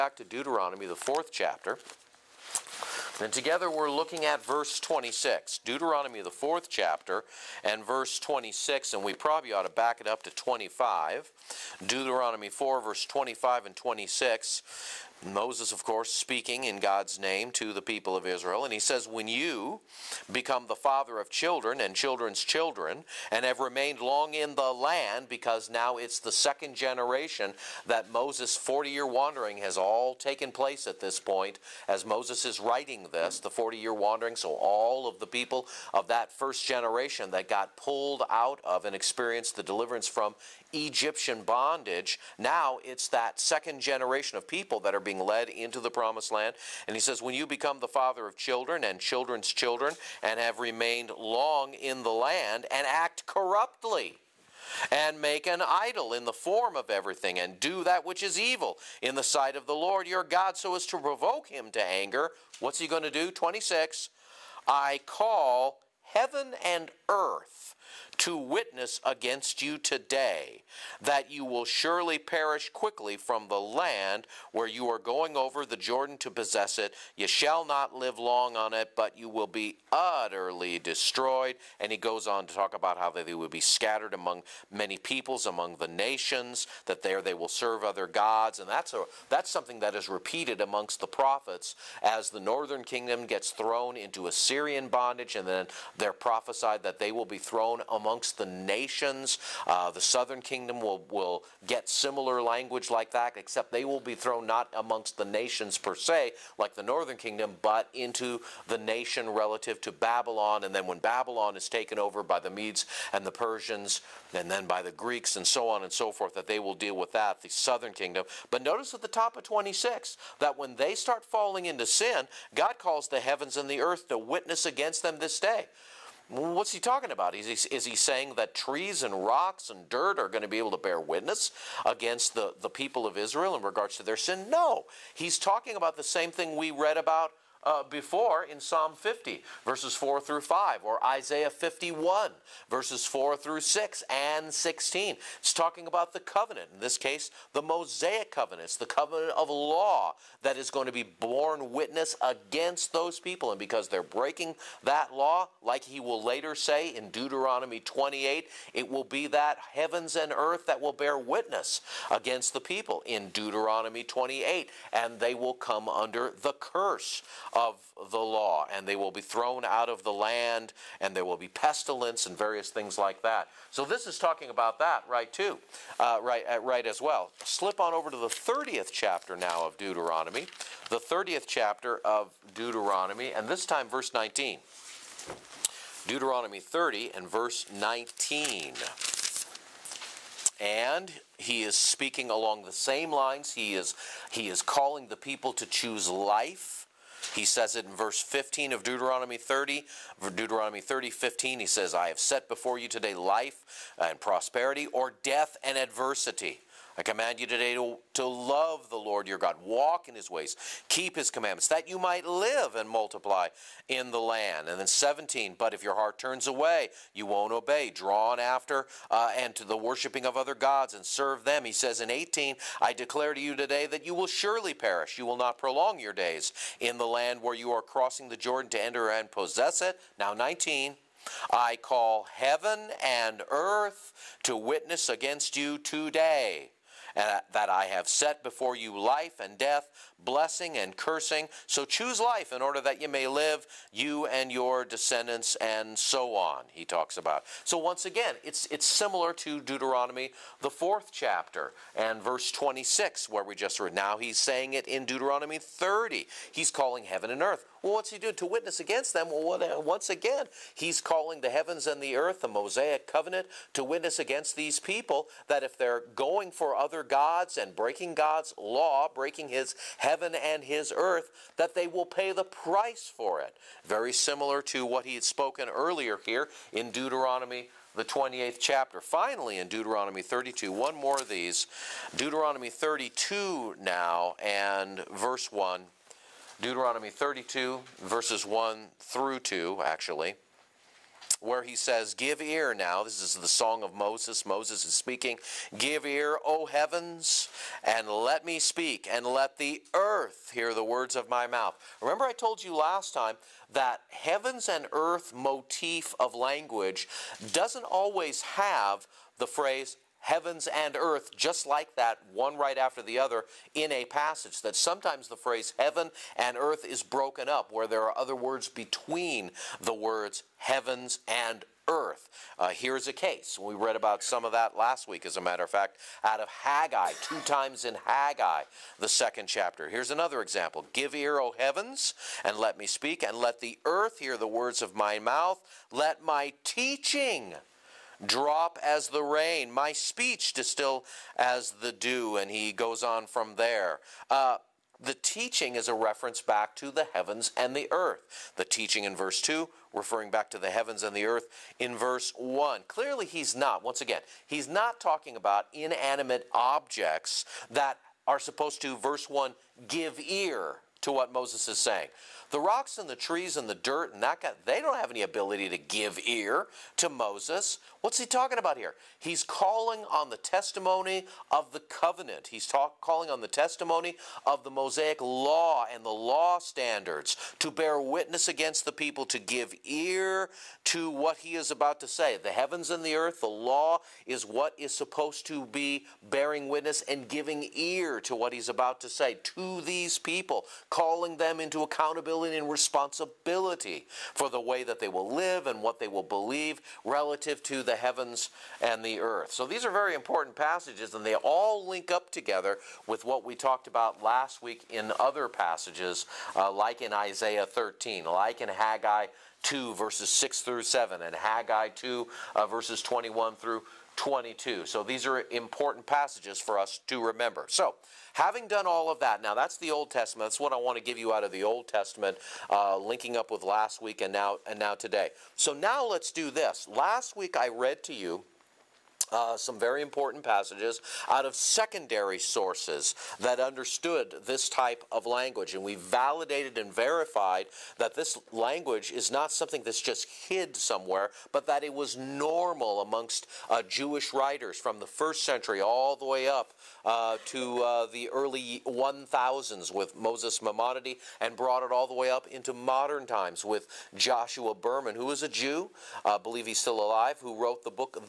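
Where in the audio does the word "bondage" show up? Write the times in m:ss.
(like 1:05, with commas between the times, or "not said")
0:41, 1:34.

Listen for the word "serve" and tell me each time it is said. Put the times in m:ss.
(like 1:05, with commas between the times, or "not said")
1:27, 3:41.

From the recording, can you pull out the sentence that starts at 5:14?
That sometimes the phrase heaven and earth is broken up, where there are other words between the words heavens and earth.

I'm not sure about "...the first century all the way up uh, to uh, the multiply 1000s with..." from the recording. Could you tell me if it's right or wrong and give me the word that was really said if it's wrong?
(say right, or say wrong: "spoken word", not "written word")
wrong: "early", not "multiply".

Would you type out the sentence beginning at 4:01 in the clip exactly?
So choose life in order that you may live, you and your descendants, and so on, he talks about.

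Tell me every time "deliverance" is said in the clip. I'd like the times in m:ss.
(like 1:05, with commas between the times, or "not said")
0:39.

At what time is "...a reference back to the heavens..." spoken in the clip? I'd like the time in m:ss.
5:45.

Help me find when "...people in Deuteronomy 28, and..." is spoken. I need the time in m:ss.
2:42.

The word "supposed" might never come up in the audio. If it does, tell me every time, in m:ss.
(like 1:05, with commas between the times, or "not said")
5:58, 6:24.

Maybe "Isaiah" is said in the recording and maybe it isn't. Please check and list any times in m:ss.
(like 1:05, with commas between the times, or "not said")
2:21, 6:47.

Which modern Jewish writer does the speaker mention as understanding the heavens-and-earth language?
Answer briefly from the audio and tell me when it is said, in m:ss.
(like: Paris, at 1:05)
Joshua Berman, at 7:34.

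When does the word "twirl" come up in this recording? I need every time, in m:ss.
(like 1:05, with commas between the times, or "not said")
not said.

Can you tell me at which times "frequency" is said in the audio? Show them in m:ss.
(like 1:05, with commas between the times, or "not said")
not said.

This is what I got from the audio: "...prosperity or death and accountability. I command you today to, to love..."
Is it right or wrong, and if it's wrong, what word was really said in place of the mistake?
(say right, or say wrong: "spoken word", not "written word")
wrong: "adversity", not "accountability".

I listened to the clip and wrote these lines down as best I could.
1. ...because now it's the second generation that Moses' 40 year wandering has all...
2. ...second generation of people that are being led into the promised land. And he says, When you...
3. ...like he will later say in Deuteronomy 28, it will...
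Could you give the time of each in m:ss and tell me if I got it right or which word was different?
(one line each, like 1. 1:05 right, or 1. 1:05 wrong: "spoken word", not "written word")
1. 0:25 right
2. 0:43 right
3. 2:35 right.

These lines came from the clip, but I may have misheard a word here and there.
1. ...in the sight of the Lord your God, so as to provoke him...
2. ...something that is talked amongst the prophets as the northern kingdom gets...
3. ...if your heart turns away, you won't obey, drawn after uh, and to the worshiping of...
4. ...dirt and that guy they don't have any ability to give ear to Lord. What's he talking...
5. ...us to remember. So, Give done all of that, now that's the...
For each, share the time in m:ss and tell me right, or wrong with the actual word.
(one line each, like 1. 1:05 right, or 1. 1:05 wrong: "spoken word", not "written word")
1. 0:59 right
2. 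1:29 wrong: "repeated", not "talked"
3. 3:35 right
4. 6:03 wrong: "Moses", not "Lord"
5. 6:56 wrong: "Having", not "Give".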